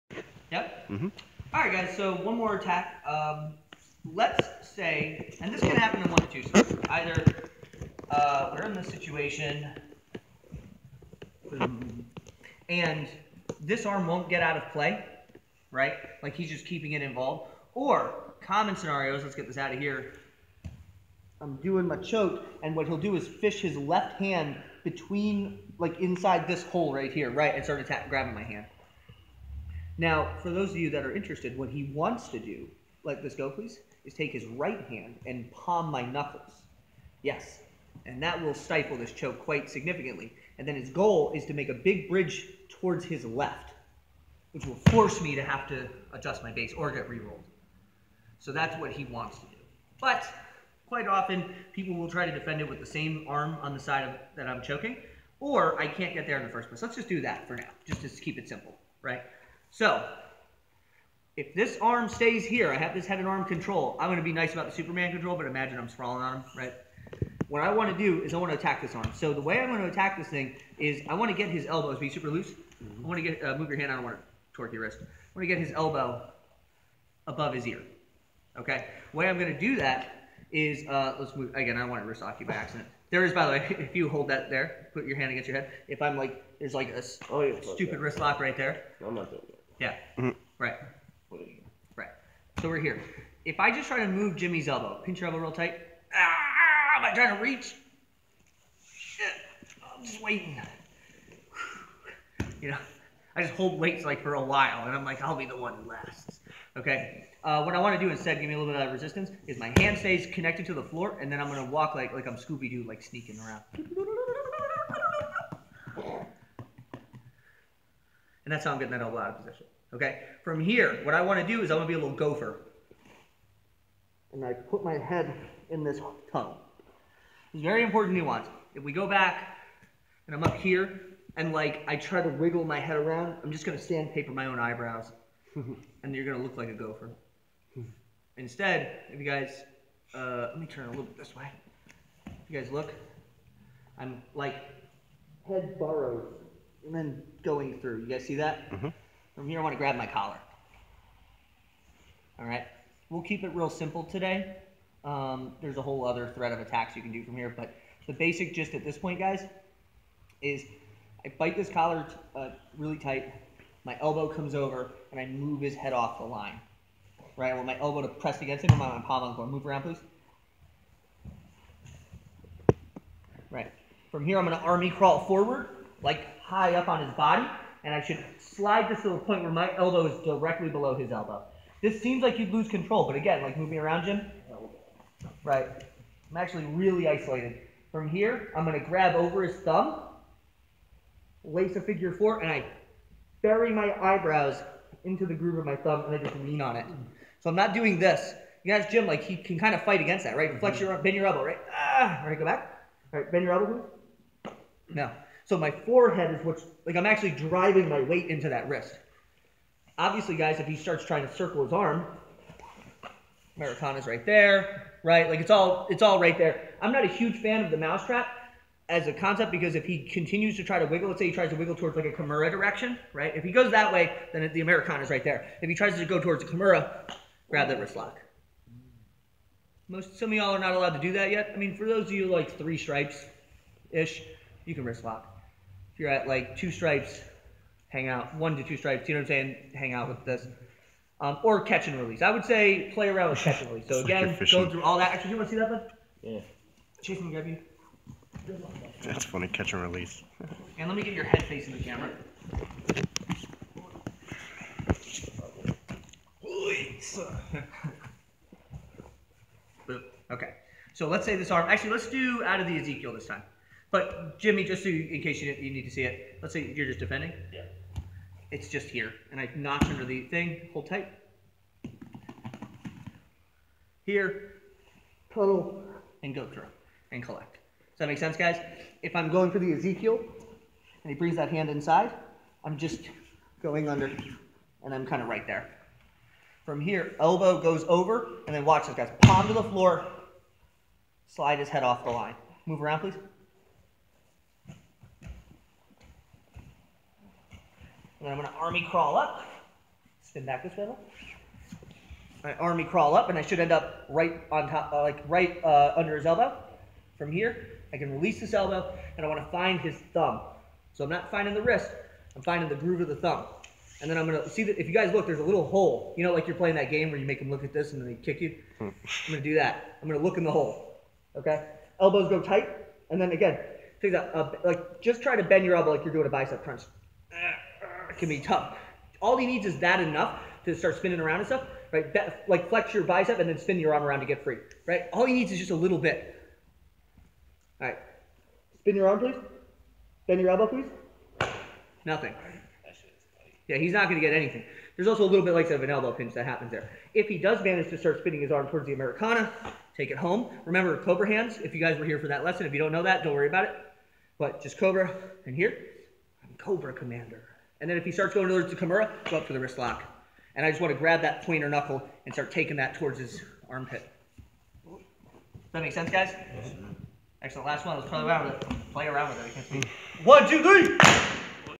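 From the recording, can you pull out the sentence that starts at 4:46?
From here, elbow goes over, and then watch this, guys.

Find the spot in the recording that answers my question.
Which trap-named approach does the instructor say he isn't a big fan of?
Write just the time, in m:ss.
3:37.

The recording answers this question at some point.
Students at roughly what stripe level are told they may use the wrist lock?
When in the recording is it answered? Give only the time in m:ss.
3:52.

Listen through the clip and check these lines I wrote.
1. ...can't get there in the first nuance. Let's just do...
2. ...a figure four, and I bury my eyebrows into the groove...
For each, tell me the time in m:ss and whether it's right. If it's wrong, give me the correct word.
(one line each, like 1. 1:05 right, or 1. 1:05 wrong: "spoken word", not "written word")
1. 0:55 wrong: "place", not "nuance"
2. 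3:11 right.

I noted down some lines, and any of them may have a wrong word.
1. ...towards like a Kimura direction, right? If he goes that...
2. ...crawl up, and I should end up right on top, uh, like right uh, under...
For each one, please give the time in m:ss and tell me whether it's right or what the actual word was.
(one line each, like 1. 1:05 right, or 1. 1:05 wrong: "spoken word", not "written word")
1. 3:41 right
2. 5:02 right.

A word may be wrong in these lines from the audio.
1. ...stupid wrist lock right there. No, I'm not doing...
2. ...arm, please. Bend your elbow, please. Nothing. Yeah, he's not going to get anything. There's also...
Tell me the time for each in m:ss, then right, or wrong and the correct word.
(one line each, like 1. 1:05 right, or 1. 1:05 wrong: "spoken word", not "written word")
1. 1:27 right
2. 5:39 right.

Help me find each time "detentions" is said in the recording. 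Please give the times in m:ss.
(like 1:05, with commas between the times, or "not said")
not said.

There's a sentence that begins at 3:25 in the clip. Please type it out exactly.
So my forehead is what's like I'm actually driving my weight into that wrist.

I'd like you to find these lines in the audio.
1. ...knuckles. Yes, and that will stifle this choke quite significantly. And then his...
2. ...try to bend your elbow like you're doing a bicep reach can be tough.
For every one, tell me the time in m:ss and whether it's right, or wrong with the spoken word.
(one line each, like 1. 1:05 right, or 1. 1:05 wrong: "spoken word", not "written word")
1. 0:36 right
2. 5:25 wrong: "crunch", not "reach".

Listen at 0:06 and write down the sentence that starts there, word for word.
Either uh, we're in this situation, and this arm won't get out of play, right?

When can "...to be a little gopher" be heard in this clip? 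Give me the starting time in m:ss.
2:01.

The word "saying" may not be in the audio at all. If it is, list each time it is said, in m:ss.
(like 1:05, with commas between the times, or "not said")
3:59.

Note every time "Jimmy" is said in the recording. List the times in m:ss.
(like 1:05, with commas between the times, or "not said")
1:34, 4:24.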